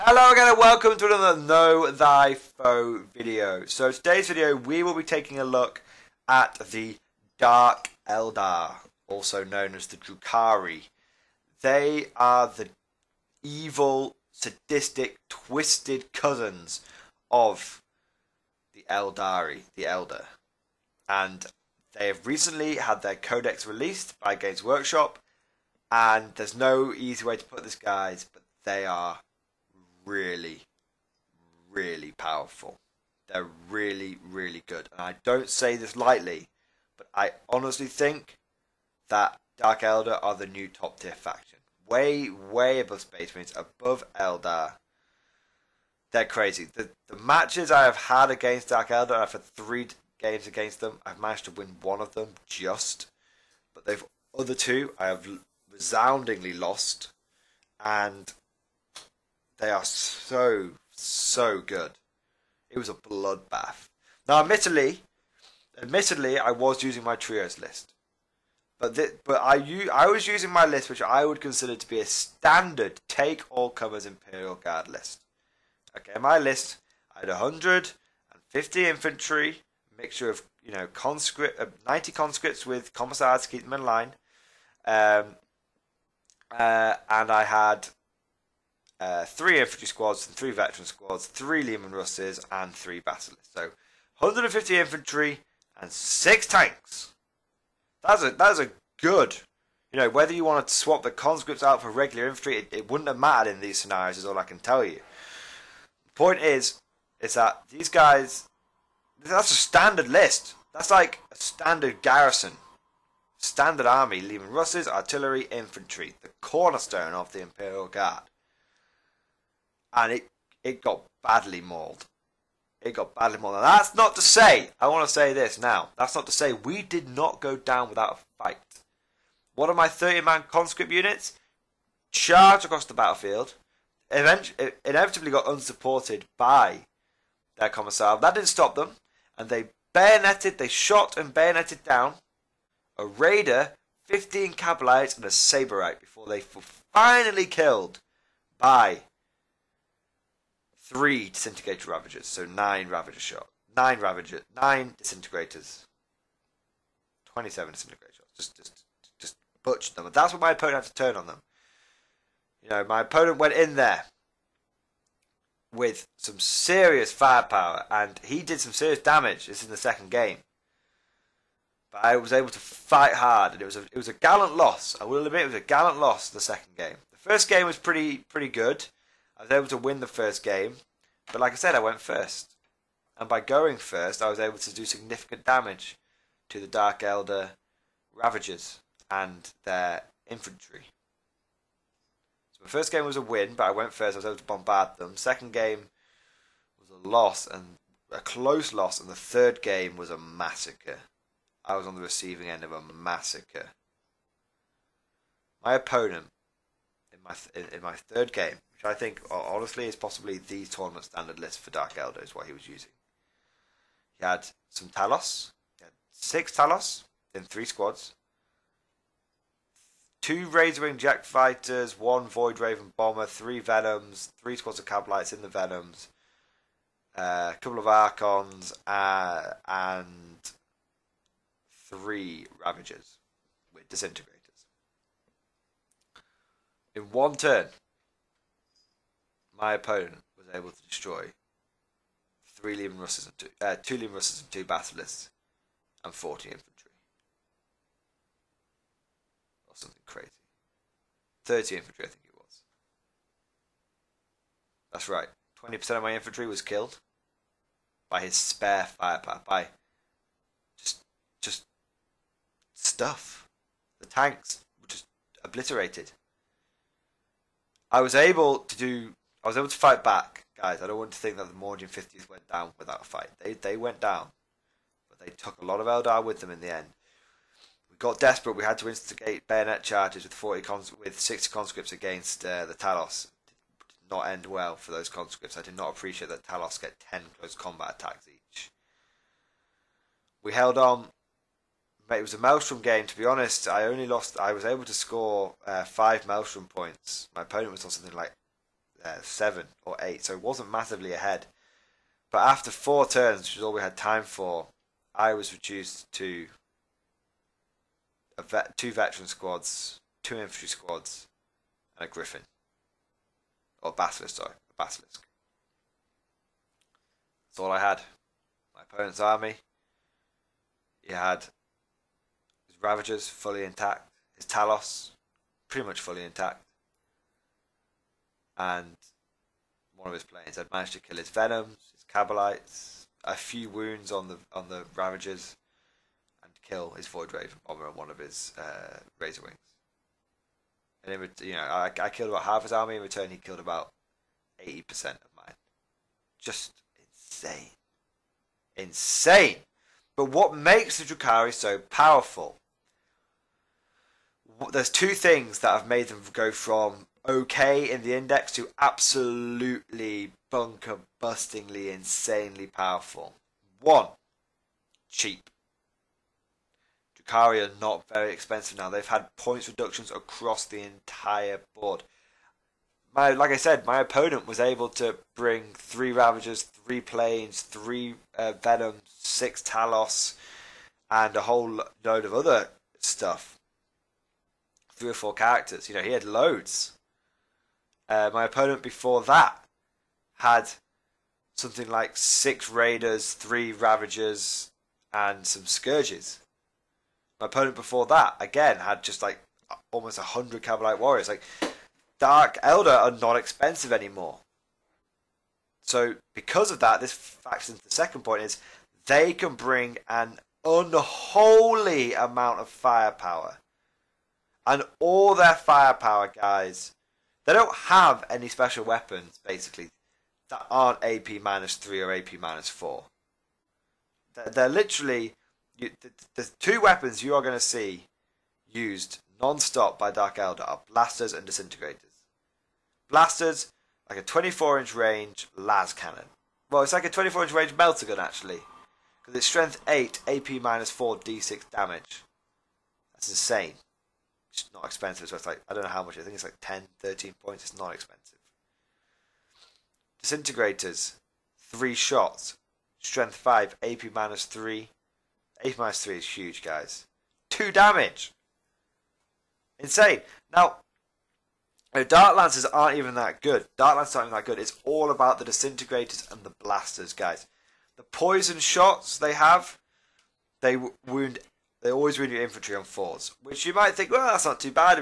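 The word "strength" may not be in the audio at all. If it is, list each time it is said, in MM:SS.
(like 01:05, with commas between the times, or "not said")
07:19, 07:33.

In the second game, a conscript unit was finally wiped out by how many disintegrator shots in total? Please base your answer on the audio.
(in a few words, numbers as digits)
27.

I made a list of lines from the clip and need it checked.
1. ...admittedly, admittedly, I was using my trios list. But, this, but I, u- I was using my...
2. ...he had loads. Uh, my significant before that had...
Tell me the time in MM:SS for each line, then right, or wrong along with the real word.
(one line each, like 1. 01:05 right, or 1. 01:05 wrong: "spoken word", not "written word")
1. 01:04 right
2. 06:26 wrong: "opponent", not "significant".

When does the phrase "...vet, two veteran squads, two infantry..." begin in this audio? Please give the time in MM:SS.
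05:08.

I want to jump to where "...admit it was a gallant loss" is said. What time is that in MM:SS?
02:55.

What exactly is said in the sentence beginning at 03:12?
So my first game was a win, but I went first.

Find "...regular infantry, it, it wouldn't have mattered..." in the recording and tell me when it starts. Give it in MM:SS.
01:41.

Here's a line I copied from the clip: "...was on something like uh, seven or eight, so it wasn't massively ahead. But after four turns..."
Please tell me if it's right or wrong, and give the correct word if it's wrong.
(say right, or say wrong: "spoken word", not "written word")
right.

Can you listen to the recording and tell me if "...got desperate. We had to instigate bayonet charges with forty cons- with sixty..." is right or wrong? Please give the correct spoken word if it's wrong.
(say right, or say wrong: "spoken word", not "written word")
right.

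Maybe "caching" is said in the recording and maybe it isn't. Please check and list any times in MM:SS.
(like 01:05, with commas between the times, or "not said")
not said.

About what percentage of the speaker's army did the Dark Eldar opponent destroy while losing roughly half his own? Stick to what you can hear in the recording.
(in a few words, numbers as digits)
80%.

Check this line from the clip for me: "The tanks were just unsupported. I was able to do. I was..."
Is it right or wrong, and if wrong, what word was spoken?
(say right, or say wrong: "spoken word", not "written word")
wrong: "obliterated", not "unsupported".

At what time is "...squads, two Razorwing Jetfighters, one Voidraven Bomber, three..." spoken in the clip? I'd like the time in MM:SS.
03:37.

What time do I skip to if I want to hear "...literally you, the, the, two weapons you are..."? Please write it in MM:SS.
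07:04.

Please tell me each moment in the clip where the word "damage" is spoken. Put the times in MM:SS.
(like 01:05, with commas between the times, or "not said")
02:48, 03:05, 07:21, 07:37.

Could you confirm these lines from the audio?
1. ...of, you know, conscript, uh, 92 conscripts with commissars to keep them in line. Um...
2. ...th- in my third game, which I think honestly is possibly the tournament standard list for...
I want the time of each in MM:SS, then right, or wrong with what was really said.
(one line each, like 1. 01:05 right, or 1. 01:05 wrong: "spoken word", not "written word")
1. 01:20 wrong: "90", not "92"
2. 03:27 right.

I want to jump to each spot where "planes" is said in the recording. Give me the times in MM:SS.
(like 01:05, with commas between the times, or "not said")
05:30, 06:17.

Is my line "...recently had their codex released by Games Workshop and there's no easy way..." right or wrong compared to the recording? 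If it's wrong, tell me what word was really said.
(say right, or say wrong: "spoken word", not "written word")
right.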